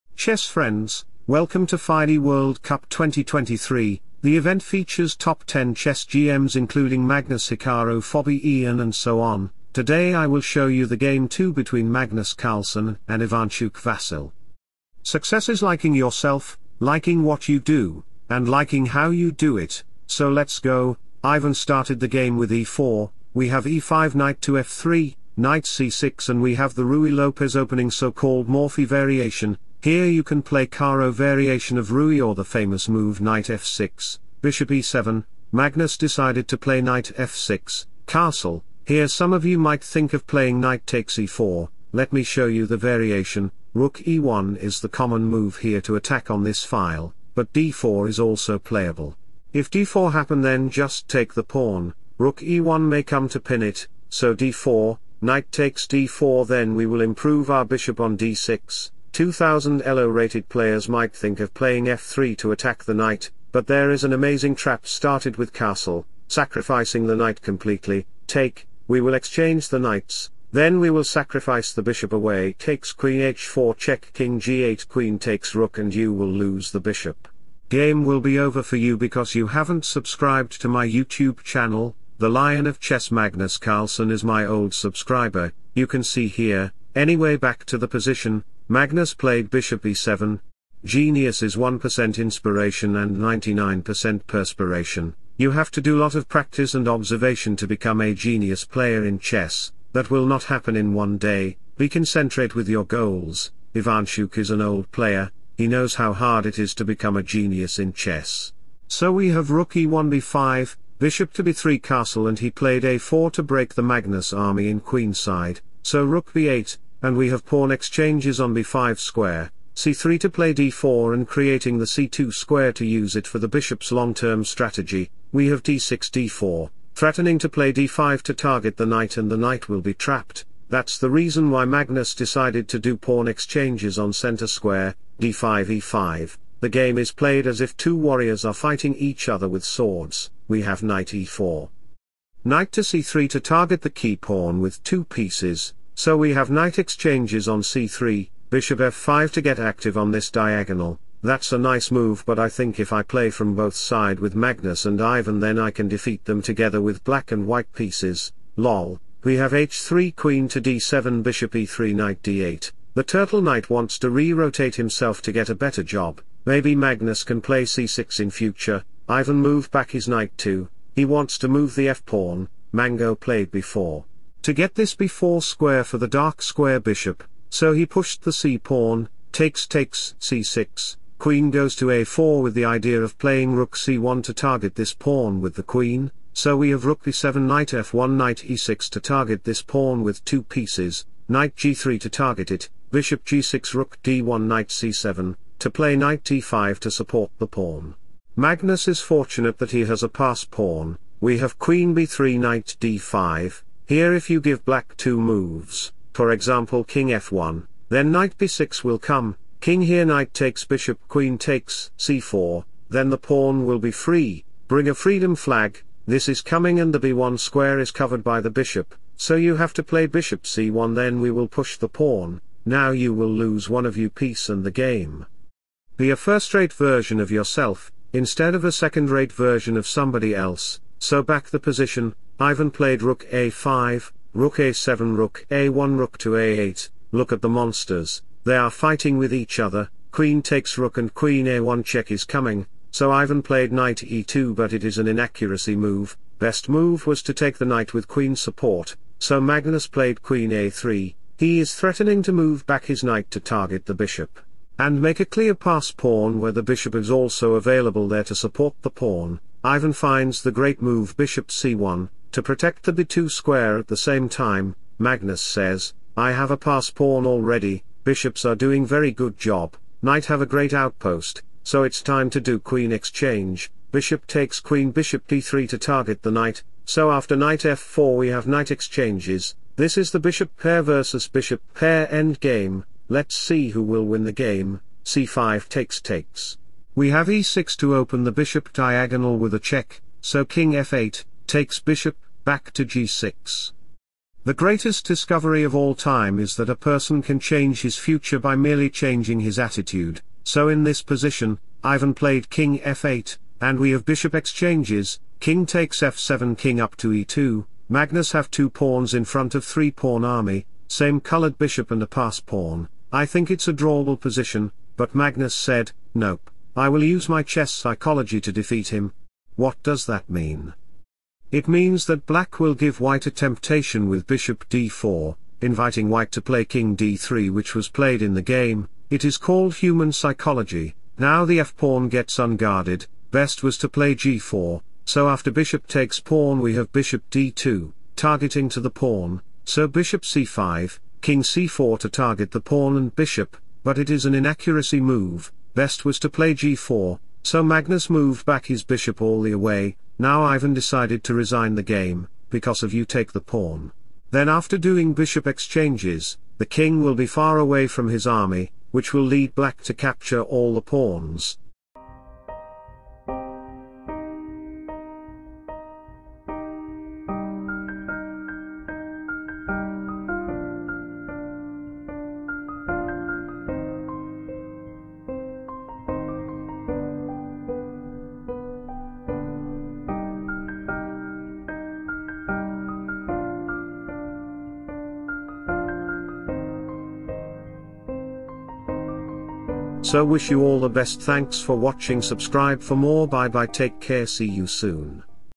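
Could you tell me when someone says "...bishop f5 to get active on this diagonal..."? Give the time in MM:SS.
02:28.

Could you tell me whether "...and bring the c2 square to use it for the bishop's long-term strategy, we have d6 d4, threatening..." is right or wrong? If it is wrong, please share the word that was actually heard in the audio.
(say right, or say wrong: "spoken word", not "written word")
wrong: "creating", not "bring".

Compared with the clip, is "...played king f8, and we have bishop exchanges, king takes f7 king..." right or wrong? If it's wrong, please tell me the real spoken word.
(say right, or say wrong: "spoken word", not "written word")
right.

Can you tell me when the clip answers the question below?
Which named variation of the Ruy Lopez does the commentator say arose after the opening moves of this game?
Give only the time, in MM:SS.
00:28.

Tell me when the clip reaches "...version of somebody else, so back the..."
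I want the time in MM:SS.
03:49.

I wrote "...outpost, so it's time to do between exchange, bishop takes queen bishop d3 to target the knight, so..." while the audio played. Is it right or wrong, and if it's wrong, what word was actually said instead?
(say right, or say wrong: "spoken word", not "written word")
wrong: "queen", not "between".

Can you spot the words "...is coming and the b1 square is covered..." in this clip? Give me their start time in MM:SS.
03:36.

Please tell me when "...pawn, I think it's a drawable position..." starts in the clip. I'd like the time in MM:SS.
05:12.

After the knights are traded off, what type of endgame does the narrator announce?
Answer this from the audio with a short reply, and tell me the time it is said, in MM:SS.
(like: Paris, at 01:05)
bishop pair versus bishop pair, at 04:40.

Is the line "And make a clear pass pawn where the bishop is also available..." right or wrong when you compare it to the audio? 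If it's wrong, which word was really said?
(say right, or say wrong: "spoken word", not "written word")
right.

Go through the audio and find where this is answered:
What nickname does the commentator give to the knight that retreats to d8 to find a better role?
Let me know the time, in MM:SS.
02:43.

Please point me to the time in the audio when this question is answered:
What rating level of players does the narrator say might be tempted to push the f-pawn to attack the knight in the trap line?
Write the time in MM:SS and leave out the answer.
00:59.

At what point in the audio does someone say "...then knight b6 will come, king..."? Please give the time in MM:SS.
03:27.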